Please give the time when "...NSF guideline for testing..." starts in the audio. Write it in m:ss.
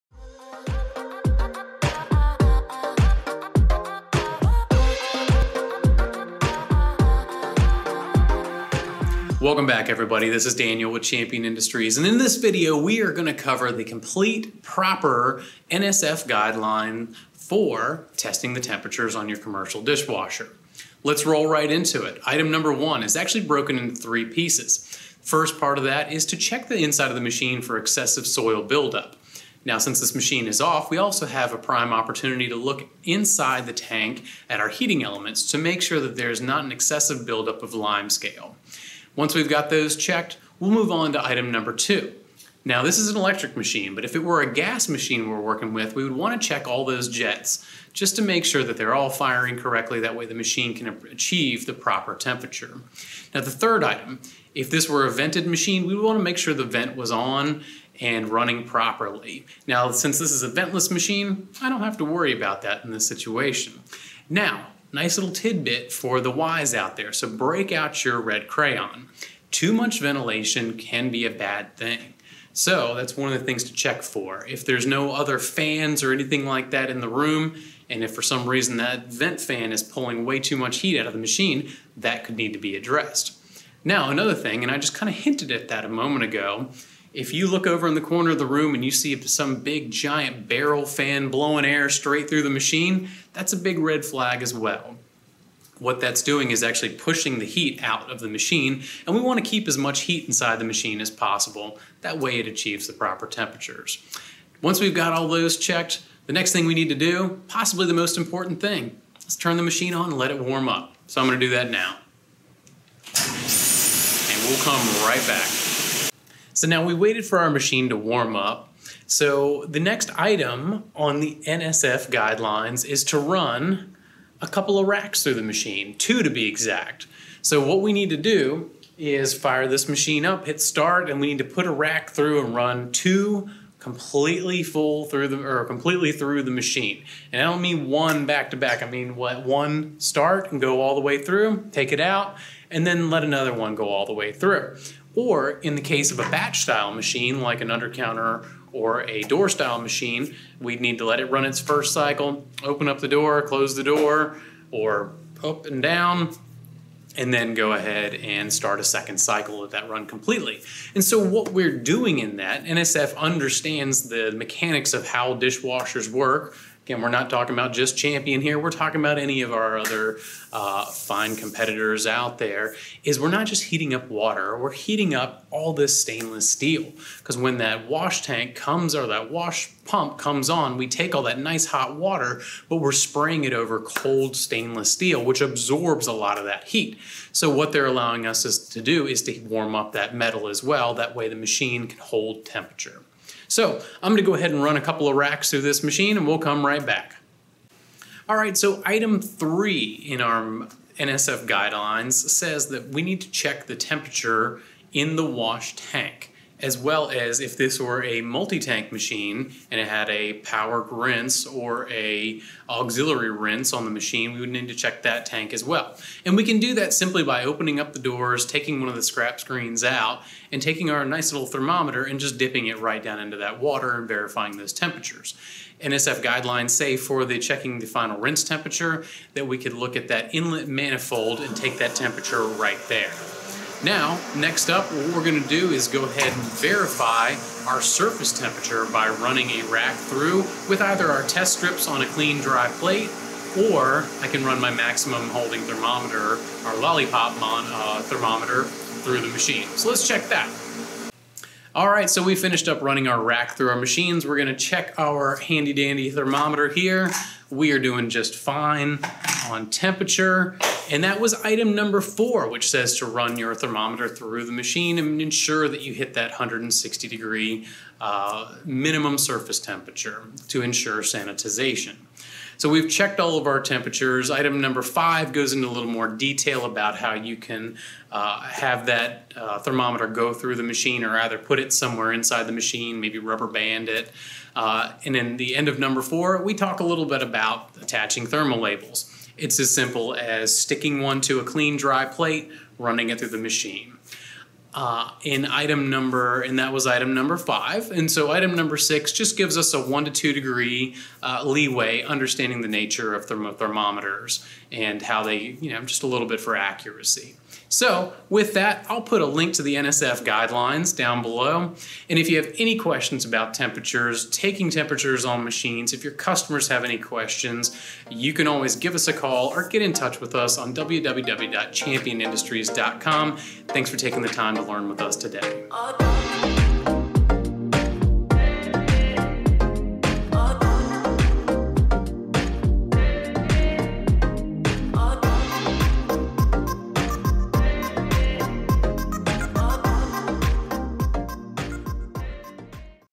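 0:15.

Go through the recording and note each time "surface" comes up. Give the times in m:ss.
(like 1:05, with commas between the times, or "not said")
3:57, 4:29.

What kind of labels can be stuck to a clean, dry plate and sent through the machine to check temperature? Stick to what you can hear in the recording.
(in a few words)
thermal labels.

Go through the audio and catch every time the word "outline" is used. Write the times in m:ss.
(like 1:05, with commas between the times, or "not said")
not said.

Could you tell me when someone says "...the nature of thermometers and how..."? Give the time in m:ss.
5:02.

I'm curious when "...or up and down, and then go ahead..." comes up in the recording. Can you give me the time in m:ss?
2:34.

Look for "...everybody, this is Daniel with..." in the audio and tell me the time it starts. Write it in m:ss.
0:09.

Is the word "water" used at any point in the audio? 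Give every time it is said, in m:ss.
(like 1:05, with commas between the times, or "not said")
2:54, 3:01, 3:43.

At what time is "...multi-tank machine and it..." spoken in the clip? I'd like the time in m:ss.
3:28.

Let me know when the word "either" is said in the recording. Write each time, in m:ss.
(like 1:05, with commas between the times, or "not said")
4:00, 4:41.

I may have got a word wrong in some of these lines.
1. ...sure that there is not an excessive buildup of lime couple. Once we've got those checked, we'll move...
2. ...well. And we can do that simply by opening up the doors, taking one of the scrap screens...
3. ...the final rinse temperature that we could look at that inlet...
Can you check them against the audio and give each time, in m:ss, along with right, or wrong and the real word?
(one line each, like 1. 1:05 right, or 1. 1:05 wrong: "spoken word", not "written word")
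1. 0:35 wrong: "scale", not "couple"
2. 3:35 right
3. 3:47 right.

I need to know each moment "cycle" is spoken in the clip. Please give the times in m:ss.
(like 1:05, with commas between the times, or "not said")
2:31, 2:39.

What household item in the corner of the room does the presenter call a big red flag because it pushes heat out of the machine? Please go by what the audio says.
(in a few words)
barrel fan.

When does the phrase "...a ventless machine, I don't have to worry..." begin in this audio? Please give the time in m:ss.
1:00.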